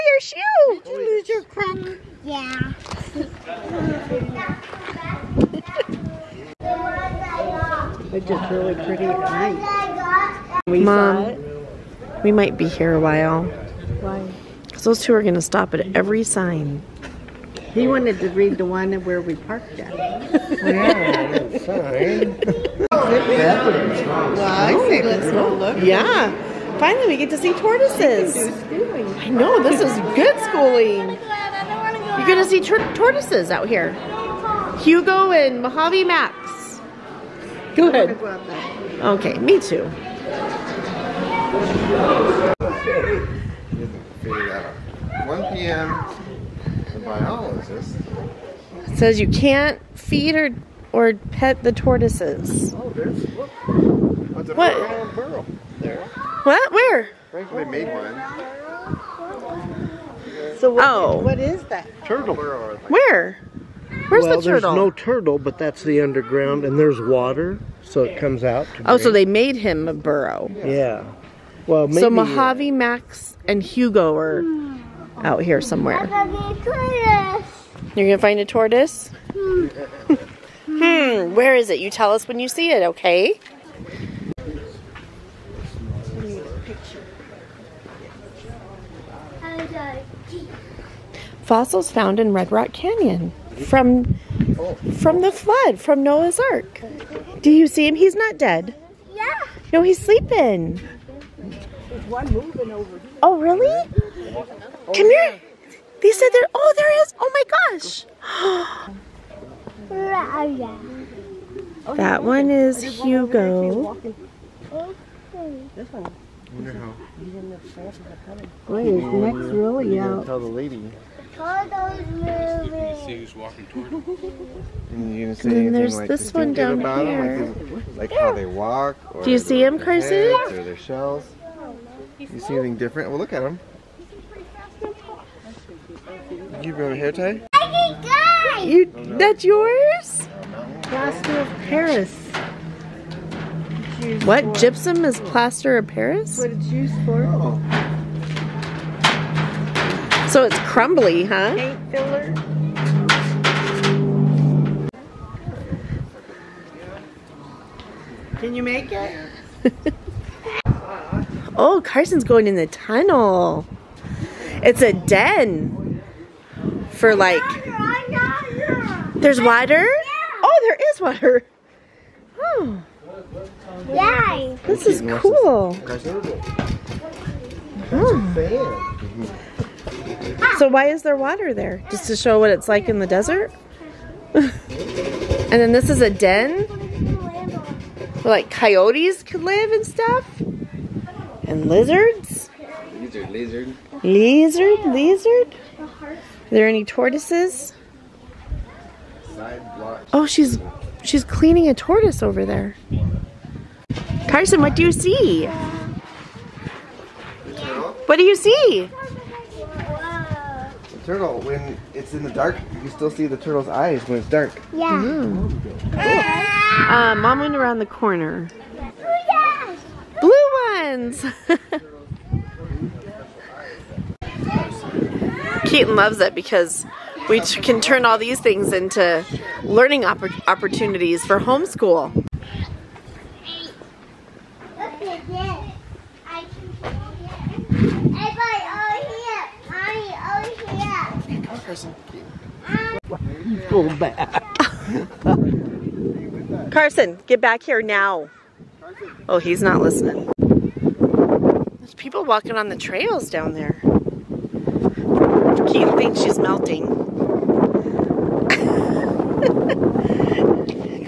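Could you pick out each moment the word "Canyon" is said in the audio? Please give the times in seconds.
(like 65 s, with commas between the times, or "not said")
92 s.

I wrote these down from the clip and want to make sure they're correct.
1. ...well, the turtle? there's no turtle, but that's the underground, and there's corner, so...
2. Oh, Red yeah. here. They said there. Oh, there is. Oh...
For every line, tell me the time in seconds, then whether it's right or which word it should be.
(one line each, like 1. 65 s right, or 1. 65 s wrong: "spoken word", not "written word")
1. 64 s wrong: "water", not "corner"
2. 104 s wrong: "Come", not "Red".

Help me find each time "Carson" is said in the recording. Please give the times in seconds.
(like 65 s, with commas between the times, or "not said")
129 s, 161 s, 204 s, 246 s.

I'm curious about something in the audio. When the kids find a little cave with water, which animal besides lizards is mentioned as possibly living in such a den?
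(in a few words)
Coyotes.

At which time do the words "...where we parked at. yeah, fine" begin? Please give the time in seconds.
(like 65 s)
19 s.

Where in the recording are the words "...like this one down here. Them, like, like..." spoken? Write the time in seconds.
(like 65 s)
125 s.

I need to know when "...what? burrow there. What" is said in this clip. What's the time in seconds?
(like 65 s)
54 s.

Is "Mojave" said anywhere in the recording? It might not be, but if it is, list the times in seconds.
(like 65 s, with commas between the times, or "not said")
35 s, 72 s.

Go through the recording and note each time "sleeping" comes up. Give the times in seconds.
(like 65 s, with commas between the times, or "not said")
99 s.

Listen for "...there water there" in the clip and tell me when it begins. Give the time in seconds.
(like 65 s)
181 s.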